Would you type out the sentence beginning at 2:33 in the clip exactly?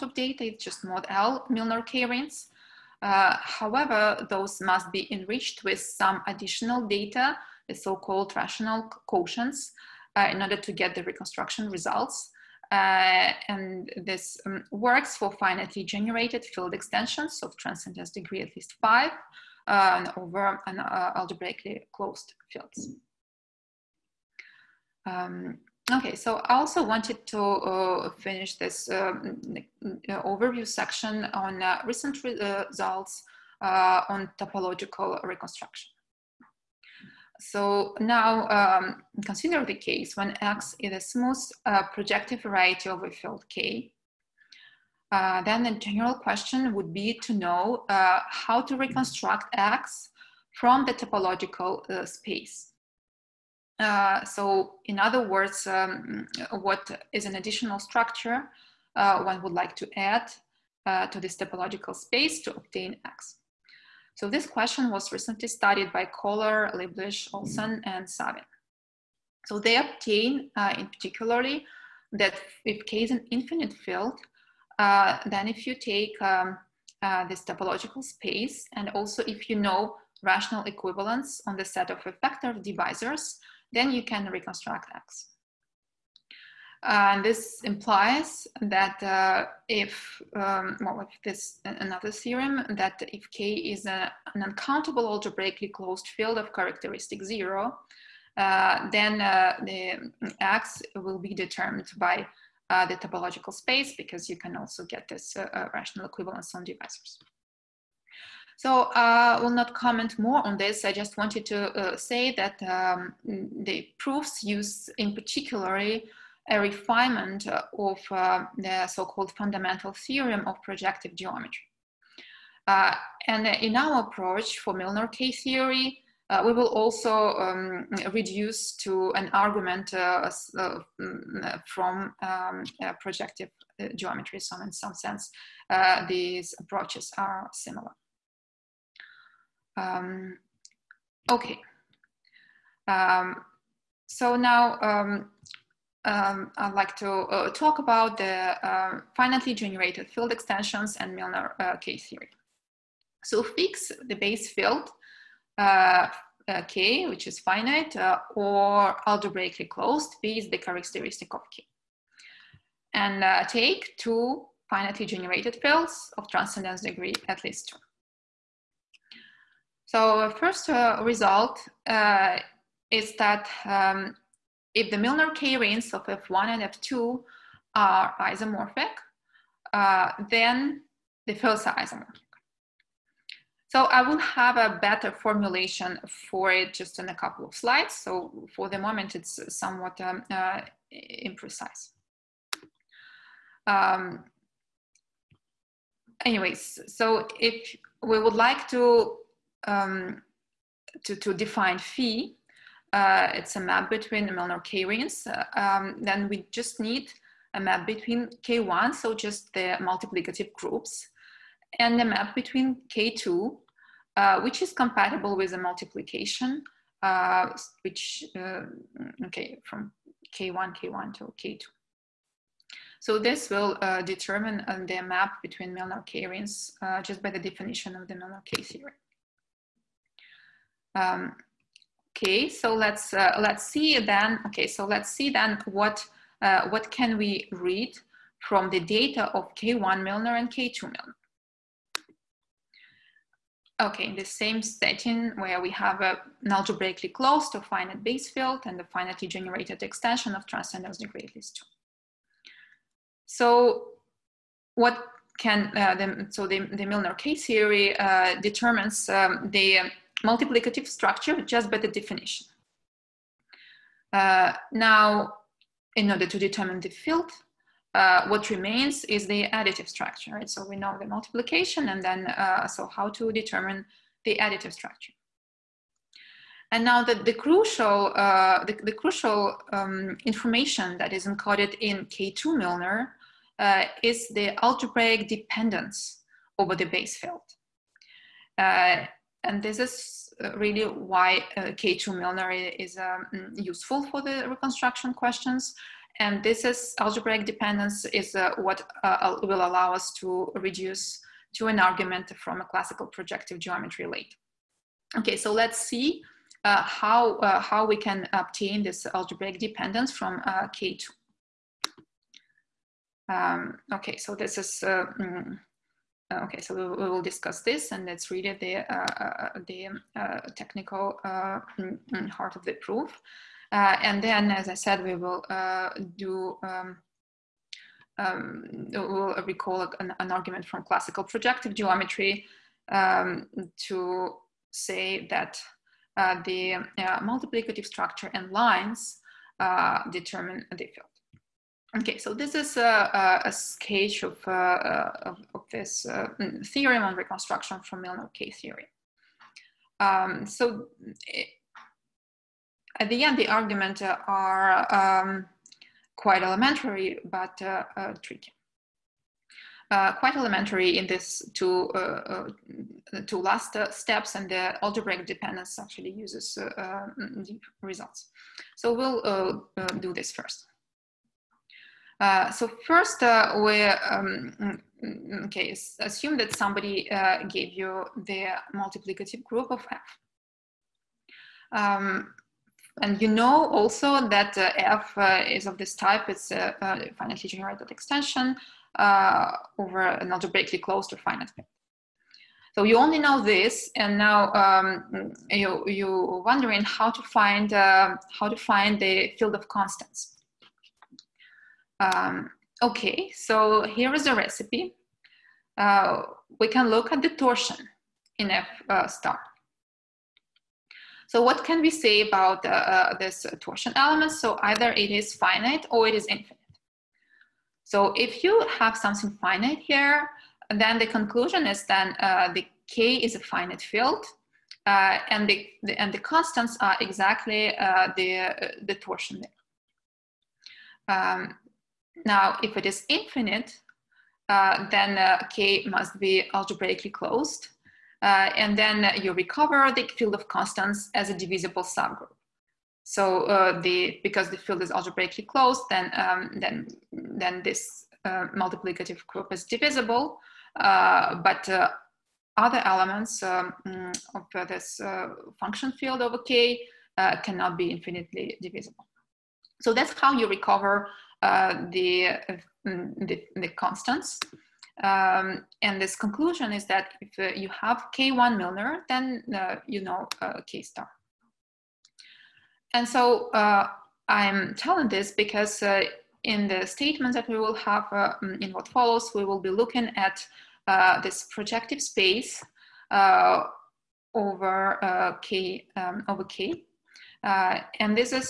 So fix the base field uh, uh, K, which is finite, uh, or algebraically closed is the characteristic of K.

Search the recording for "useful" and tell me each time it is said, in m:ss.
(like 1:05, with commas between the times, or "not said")
4:53.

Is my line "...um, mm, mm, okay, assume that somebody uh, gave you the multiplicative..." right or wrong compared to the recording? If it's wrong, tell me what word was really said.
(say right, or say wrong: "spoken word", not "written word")
right.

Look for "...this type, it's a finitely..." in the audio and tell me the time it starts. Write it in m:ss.
6:25.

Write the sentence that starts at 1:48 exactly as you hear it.
So I uh, will not comment more on this.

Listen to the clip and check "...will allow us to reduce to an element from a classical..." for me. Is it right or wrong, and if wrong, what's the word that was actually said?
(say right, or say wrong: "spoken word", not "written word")
wrong: "argument", not "element".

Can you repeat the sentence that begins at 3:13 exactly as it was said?
Um, anyways, so if we would like to, um, to, to define phi, uh, it's a map between the Milnor K-rings.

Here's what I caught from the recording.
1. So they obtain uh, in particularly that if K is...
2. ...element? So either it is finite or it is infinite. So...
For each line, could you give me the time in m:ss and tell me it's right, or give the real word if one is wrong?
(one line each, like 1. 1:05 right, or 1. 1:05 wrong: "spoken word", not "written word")
1. 1:09 right
2. 6:53 right.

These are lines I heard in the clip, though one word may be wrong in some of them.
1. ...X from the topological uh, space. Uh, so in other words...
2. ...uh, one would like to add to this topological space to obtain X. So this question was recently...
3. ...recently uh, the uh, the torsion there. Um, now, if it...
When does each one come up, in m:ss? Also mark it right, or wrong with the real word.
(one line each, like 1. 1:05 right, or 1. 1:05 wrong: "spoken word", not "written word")
1. 0:49 right
2. 0:58 right
3. 7:06 wrong: "exactly", not "recently".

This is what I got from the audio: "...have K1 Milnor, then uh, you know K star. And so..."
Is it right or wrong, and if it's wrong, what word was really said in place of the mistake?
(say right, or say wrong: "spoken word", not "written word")
right.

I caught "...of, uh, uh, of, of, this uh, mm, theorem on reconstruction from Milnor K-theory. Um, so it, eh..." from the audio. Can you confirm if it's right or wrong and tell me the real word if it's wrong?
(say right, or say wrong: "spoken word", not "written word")
right.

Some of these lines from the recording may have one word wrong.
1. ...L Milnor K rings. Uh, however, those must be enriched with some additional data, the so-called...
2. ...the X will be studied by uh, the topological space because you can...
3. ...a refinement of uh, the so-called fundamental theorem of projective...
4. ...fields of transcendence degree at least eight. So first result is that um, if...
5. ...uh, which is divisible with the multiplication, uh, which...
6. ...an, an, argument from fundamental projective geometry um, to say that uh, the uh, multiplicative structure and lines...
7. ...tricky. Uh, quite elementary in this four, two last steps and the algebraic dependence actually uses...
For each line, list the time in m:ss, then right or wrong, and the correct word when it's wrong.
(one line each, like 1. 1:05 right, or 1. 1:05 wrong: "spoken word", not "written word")
1. 0:01 right
2. 1:39 wrong: "determined", not "studied"
3. 1:56 right
4. 2:45 wrong: "two", not "eight"
5. 3:34 wrong: "compatible", not "divisible"
6. 5:29 wrong: "classical", not "fundamental"
7. 5:58 wrong: "two", not "four".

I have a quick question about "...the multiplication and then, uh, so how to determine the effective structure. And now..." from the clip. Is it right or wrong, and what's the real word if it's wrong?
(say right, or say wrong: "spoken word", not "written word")
wrong: "additive", not "effective".